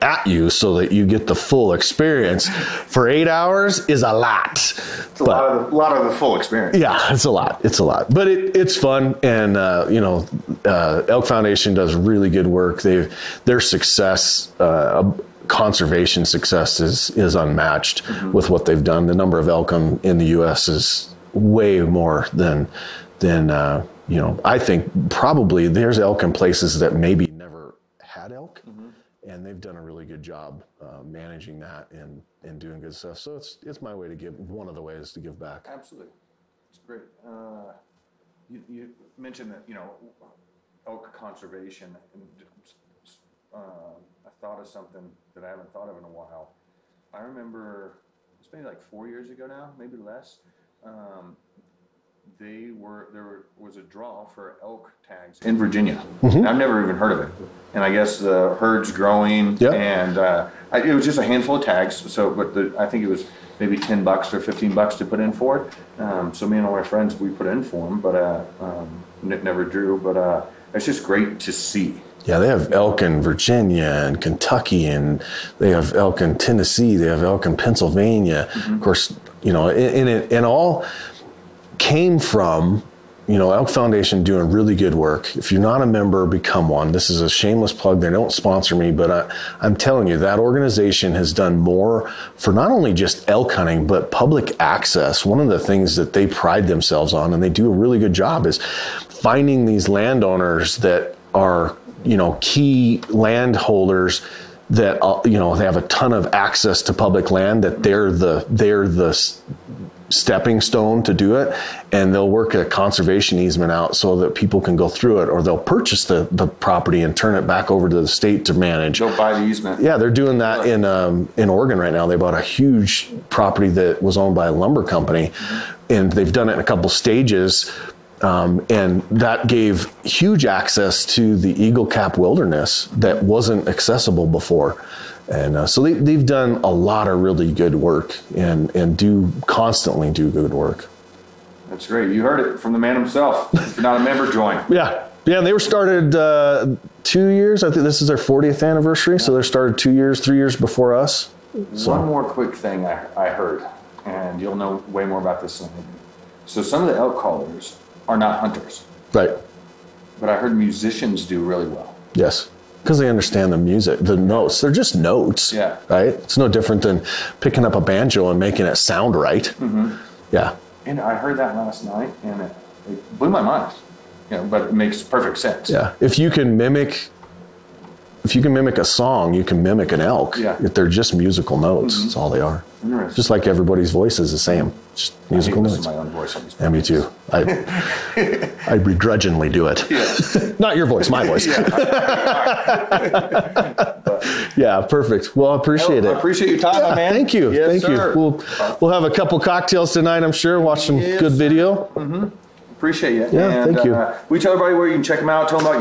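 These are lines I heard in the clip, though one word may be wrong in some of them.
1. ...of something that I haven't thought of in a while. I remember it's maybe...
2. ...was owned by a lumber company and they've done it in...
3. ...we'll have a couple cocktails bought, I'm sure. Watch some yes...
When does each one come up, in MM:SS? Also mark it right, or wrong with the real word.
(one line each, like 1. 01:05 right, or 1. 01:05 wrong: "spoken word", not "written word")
1. 00:44 right
2. 02:04 right
3. 03:18 wrong: "tonight", not "bought".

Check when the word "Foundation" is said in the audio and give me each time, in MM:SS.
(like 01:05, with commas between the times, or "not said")
00:11, 01:23.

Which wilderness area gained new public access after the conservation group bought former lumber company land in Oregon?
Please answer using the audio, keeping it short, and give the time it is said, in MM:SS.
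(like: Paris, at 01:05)
Eagle Cap wilderness, at 02:11.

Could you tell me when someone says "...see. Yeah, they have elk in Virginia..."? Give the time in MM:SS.
01:11.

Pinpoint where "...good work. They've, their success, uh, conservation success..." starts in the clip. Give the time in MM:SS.
00:12.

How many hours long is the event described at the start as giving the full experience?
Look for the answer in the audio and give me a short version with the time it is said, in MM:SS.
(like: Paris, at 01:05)
8, at 00:03.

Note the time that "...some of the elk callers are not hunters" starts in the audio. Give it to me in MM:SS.
02:36.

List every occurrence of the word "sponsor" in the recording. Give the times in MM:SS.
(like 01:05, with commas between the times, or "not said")
01:28.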